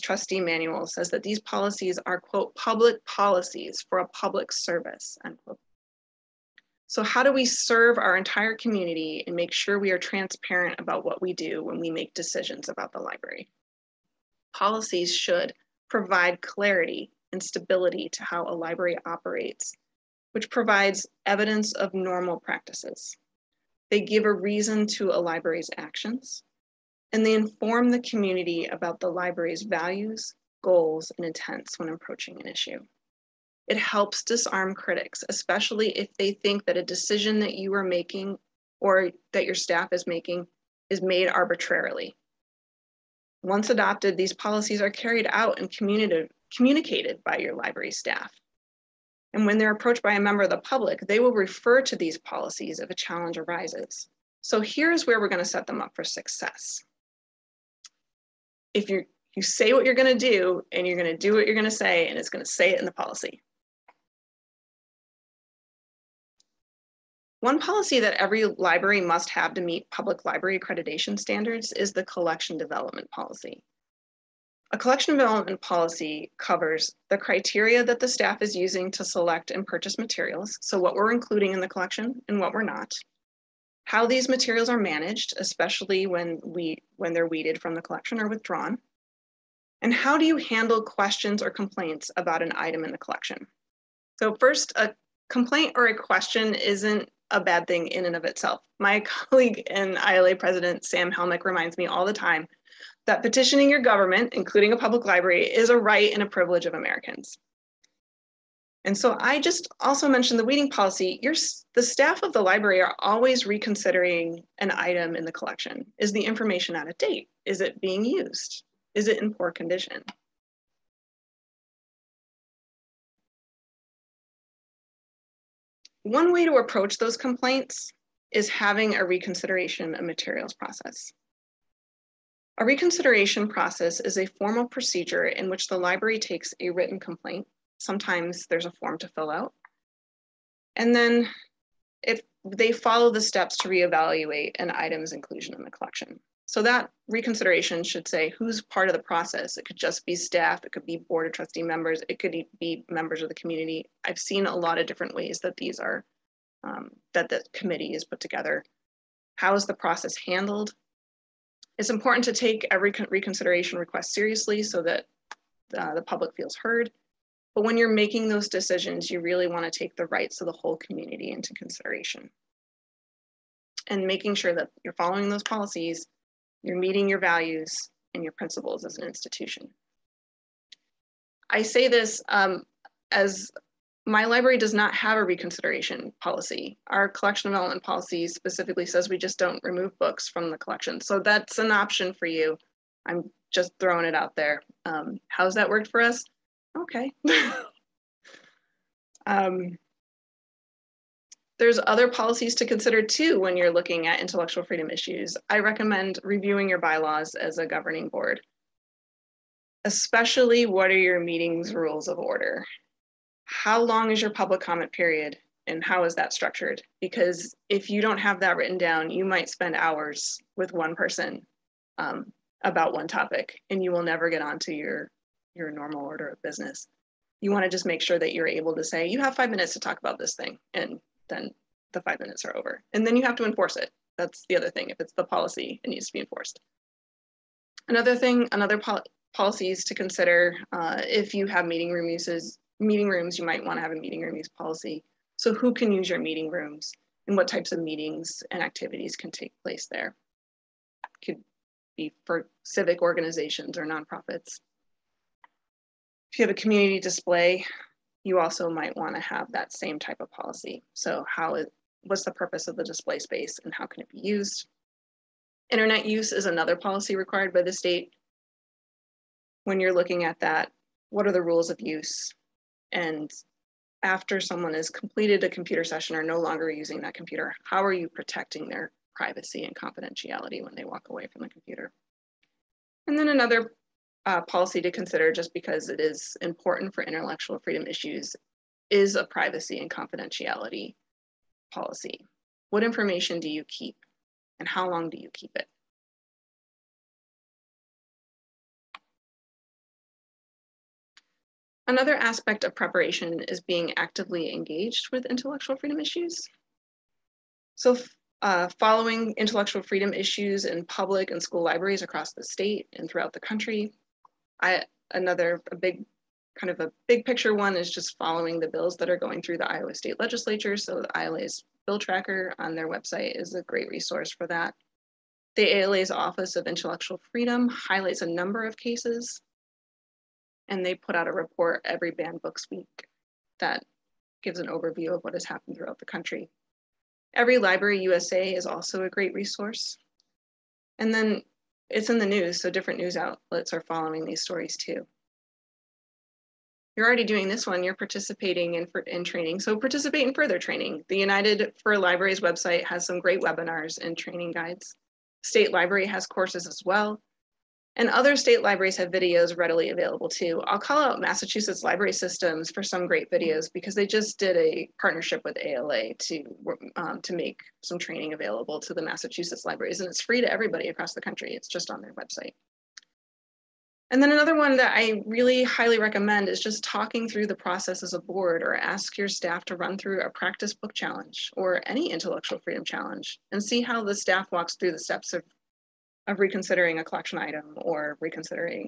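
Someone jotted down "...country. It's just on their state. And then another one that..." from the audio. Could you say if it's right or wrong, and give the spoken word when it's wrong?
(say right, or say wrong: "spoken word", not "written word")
wrong: "website", not "state".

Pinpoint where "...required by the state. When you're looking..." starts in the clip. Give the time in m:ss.
4:27.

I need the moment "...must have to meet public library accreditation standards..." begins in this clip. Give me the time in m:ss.
1:09.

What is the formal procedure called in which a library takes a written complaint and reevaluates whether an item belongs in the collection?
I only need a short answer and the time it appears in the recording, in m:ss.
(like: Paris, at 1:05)
Reconsideration process, at 2:12.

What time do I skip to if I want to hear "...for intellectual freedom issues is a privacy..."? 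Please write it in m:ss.
4:46.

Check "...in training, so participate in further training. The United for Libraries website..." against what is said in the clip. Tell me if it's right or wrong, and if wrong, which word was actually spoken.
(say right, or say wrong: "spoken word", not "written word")
right.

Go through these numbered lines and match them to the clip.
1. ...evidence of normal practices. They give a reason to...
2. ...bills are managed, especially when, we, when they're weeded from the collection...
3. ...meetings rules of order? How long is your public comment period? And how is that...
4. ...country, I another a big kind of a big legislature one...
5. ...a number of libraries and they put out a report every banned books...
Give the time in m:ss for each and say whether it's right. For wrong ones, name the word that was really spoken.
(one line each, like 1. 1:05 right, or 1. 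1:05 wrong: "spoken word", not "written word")
1. 0:21 right
2. 1:24 wrong: "materials", not "bills"
3. 3:31 right
4. 5:13 wrong: "picture", not "legislature"
5. 5:28 wrong: "cases", not "libraries".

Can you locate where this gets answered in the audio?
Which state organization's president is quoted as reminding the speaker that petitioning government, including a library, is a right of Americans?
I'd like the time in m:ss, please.
1:40.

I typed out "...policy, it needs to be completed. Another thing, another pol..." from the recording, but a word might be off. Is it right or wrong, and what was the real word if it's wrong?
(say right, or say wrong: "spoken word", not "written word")
wrong: "enforced", not "completed".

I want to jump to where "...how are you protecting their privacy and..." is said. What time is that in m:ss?
4:37.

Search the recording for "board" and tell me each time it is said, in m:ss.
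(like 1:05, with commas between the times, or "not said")
2:31, 3:28, 6:18.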